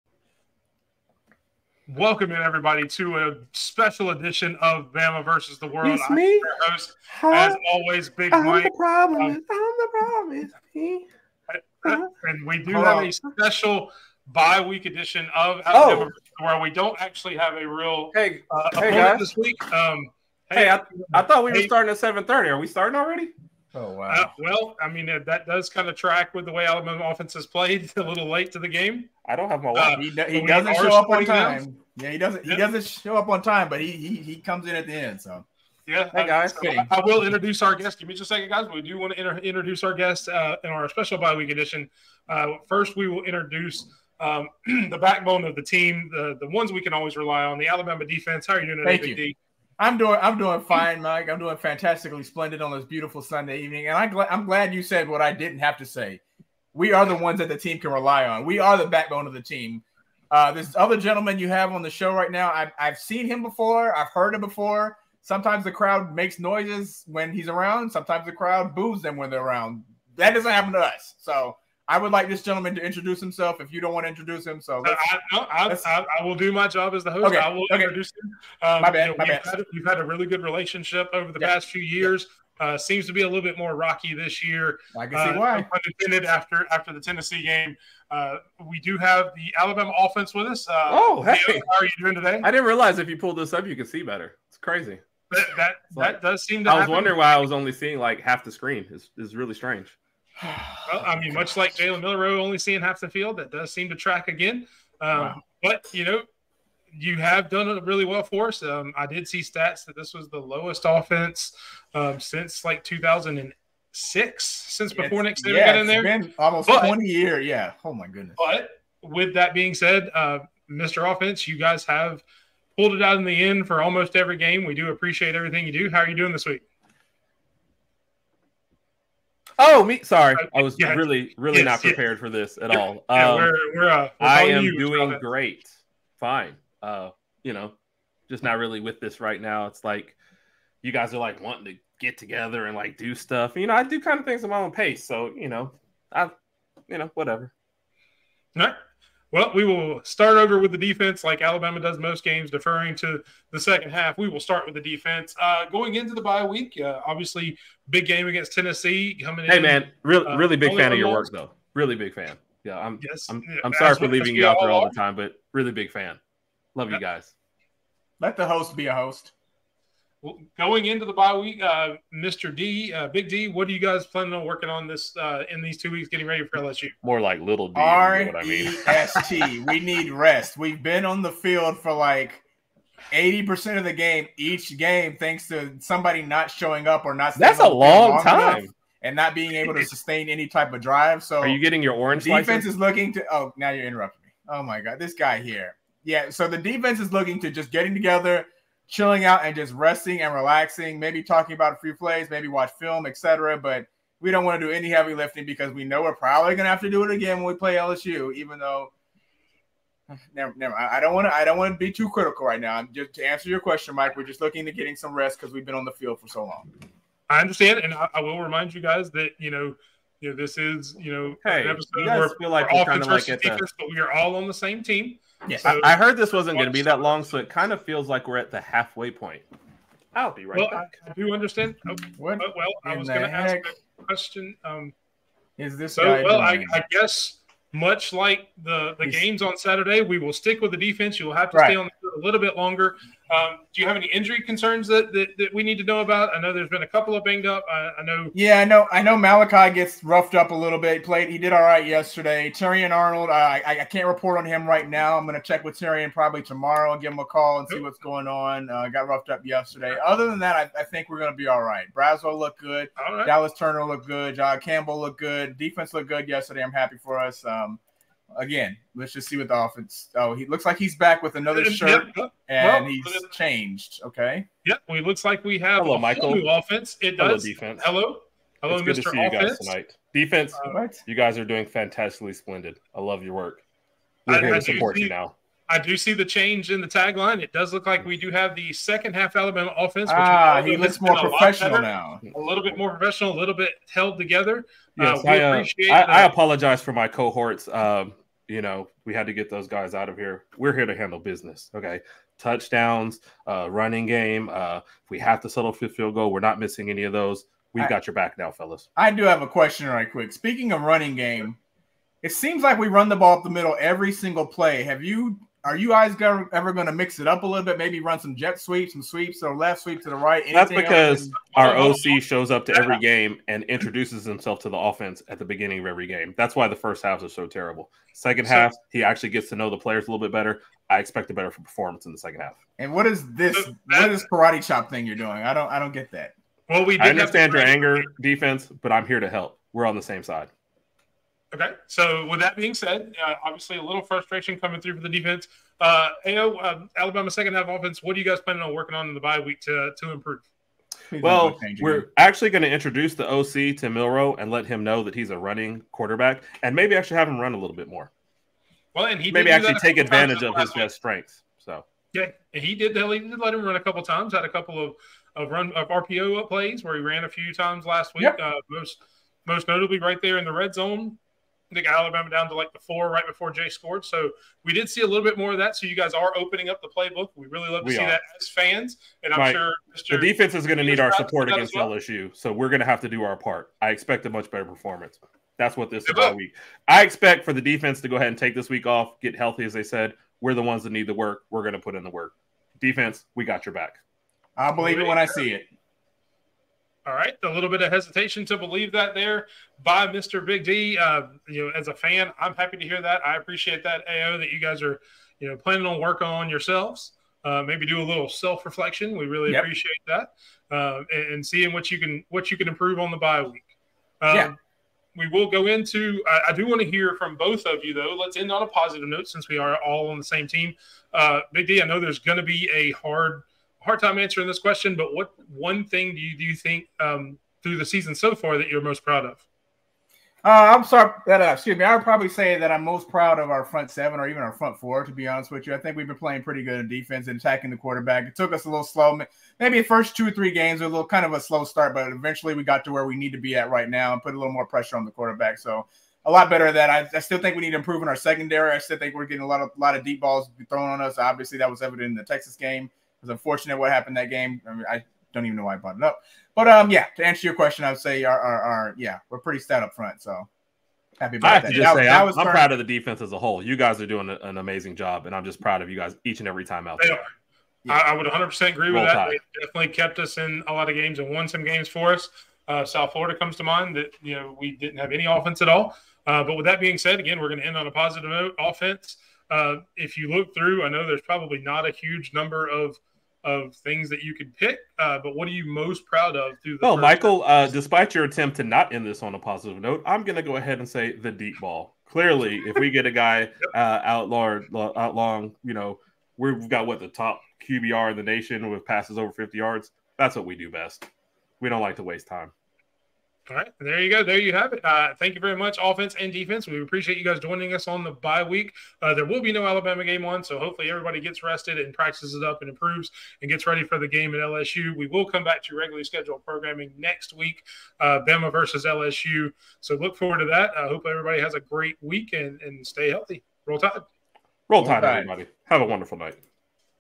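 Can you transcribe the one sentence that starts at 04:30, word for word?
Oh, he looks like he's back with another shirt, yep.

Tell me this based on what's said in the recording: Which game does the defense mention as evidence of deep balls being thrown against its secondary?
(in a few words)
Texas.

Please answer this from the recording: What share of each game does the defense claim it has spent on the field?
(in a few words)
80 percent.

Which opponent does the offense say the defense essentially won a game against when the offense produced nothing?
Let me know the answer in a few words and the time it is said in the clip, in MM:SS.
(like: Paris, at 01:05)
South Florida, at 07:52.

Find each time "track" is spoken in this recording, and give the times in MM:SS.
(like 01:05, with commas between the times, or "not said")
00:25, 01:43.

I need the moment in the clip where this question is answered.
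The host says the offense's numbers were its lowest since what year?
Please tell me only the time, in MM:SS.
01:52.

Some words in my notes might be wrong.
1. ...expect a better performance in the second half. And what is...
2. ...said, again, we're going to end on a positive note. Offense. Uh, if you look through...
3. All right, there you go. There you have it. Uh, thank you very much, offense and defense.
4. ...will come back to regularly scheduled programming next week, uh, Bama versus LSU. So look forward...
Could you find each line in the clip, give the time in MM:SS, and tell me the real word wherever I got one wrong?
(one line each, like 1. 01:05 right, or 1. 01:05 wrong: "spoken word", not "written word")
1. 05:30 right
2. 07:56 right
3. 08:23 right
4. 08:35 right.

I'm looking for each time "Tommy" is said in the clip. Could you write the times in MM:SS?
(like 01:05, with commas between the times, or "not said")
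not said.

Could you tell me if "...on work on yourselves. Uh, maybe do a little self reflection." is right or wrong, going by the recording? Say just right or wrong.
right.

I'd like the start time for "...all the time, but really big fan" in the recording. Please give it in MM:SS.
02:44.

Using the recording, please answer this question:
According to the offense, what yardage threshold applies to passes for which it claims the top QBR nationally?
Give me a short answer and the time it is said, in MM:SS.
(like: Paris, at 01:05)
50 yards, at 08:19.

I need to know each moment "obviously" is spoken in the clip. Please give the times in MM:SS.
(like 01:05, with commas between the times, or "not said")
02:37, 05:43, 07:31.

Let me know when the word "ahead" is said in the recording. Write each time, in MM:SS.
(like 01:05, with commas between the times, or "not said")
06:28, 08:10.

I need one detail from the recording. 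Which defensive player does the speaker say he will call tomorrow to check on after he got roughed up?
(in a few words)
Terrion Arnold.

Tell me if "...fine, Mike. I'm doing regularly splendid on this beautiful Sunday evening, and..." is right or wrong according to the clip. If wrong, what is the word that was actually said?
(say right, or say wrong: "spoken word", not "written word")
wrong: "fantastically", not "regularly".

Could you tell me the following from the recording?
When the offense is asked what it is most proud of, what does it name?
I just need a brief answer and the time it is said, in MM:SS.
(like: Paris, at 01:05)
The deep ball, at 08:11.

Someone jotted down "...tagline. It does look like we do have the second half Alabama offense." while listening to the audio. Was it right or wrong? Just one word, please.
right.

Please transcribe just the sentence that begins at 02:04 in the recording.
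We do appreciate everything you do.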